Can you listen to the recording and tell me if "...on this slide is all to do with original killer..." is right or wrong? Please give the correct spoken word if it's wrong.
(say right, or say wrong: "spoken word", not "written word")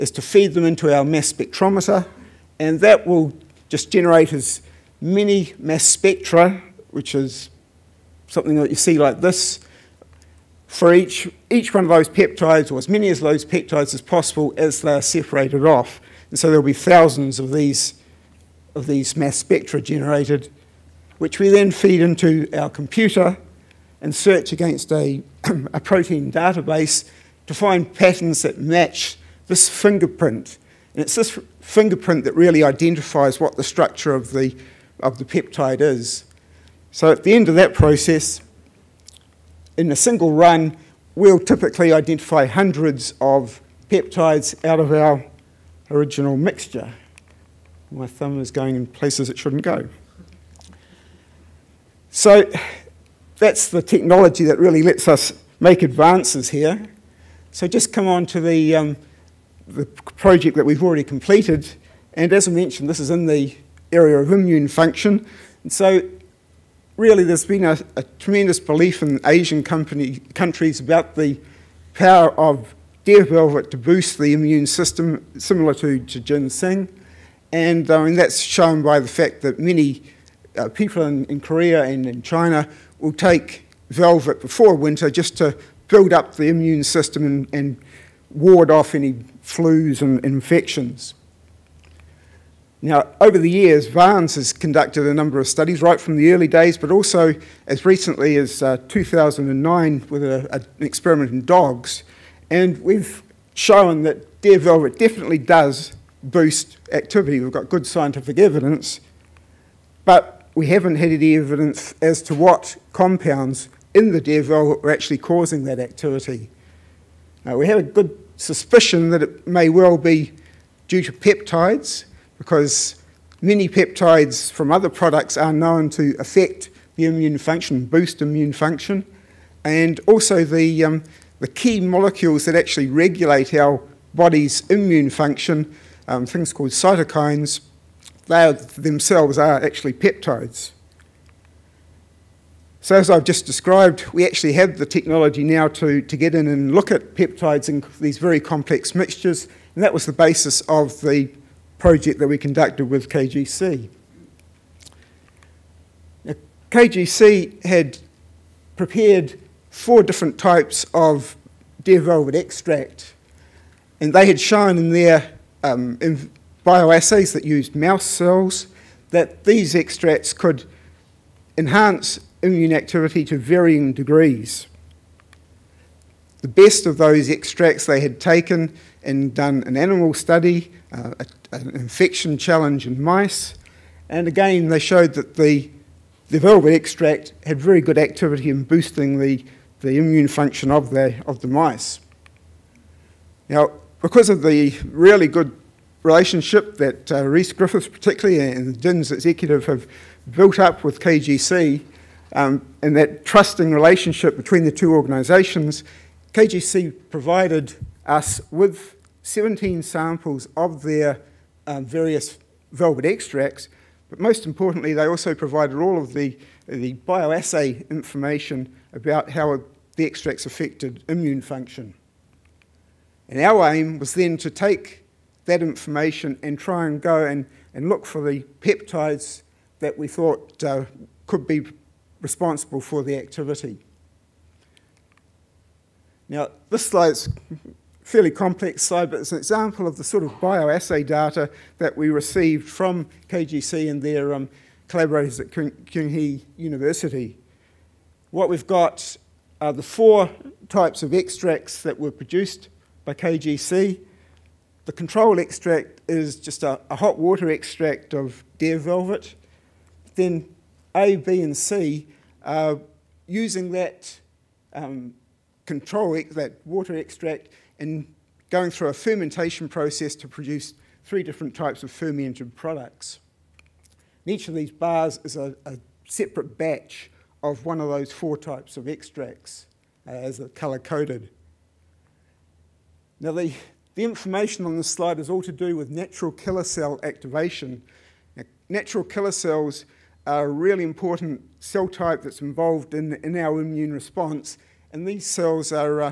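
wrong: "natural", not "original".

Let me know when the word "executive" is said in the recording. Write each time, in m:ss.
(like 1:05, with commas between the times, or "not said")
3:19.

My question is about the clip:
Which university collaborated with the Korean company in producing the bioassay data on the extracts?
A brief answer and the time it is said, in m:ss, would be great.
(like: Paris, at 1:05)
Kyung-hee University, at 4:05.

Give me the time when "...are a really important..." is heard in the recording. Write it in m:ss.
4:50.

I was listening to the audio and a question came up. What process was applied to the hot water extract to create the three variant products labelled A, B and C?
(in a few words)
Fermentation.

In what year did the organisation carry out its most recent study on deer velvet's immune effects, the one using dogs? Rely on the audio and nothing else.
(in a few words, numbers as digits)
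2009.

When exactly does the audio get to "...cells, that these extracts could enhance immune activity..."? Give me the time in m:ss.
2:48.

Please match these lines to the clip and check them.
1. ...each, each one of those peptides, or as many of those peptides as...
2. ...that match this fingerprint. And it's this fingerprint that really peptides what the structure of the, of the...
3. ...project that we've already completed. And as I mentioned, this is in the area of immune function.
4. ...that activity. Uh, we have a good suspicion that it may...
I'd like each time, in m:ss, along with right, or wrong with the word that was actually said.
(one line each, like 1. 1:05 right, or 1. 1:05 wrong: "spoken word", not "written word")
1. 0:10 right
2. 0:28 wrong: "identifies", not "peptides"
3. 0:59 right
4. 1:55 right.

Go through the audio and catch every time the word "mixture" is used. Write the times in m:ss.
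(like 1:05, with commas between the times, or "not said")
0:46, 2:28.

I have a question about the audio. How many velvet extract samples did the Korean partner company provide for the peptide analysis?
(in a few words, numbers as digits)
17.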